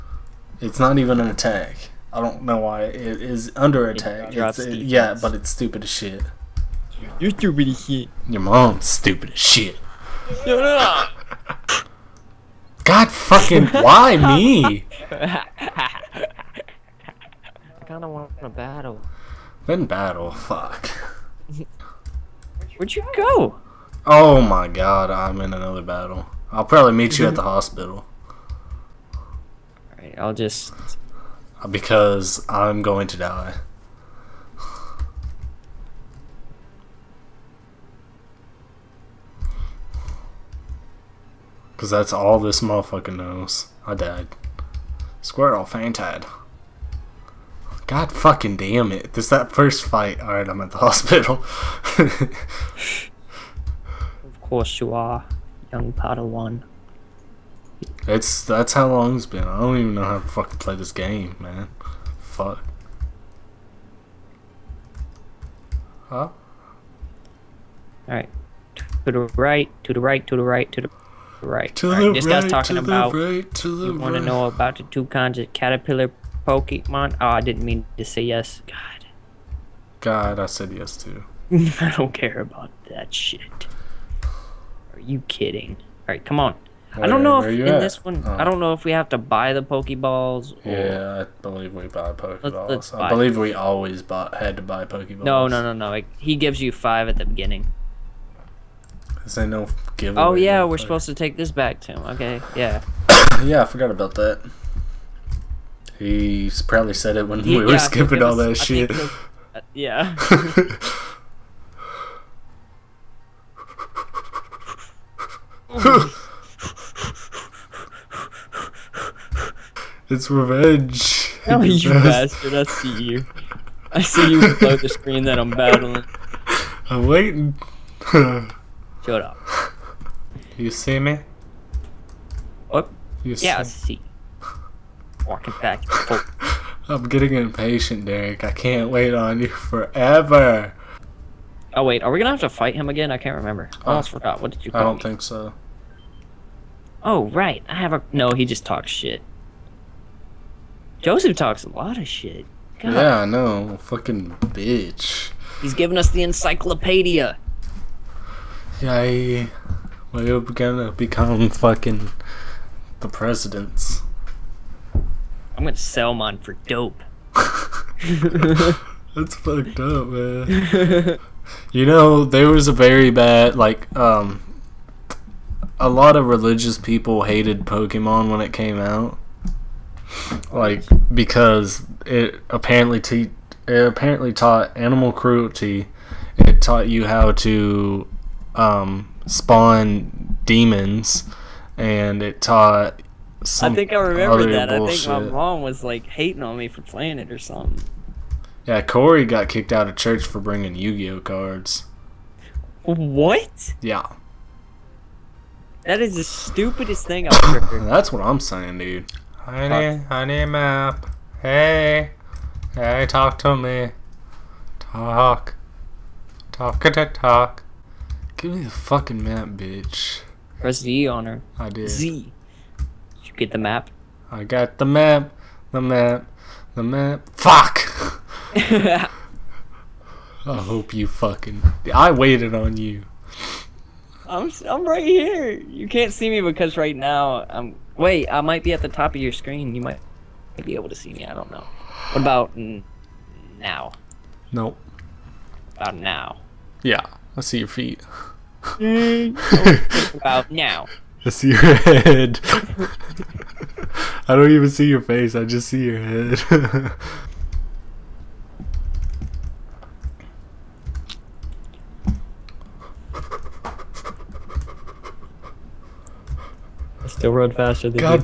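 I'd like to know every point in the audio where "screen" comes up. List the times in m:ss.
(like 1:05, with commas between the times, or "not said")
2:04, 3:59.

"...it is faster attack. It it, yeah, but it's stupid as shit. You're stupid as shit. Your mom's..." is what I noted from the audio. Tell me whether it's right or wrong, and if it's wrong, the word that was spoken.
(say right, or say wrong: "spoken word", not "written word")
wrong: "under", not "faster".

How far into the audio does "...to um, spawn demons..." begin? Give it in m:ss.
3:07.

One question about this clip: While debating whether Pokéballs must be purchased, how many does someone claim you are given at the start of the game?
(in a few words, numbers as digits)
5.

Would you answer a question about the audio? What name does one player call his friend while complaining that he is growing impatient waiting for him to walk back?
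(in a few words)
Derek.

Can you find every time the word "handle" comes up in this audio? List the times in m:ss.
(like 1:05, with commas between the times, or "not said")
not said.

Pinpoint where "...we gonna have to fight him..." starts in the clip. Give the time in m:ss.
2:22.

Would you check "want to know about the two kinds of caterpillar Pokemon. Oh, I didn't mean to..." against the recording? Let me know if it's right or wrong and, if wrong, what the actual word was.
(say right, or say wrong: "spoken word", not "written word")
right.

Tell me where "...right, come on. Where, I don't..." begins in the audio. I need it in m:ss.
1:26.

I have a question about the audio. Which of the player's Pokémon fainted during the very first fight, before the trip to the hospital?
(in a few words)
Squirtle.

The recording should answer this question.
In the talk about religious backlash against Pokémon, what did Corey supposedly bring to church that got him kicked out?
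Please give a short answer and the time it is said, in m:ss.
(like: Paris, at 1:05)
Yu-Gi-Oh cards, at 3:20.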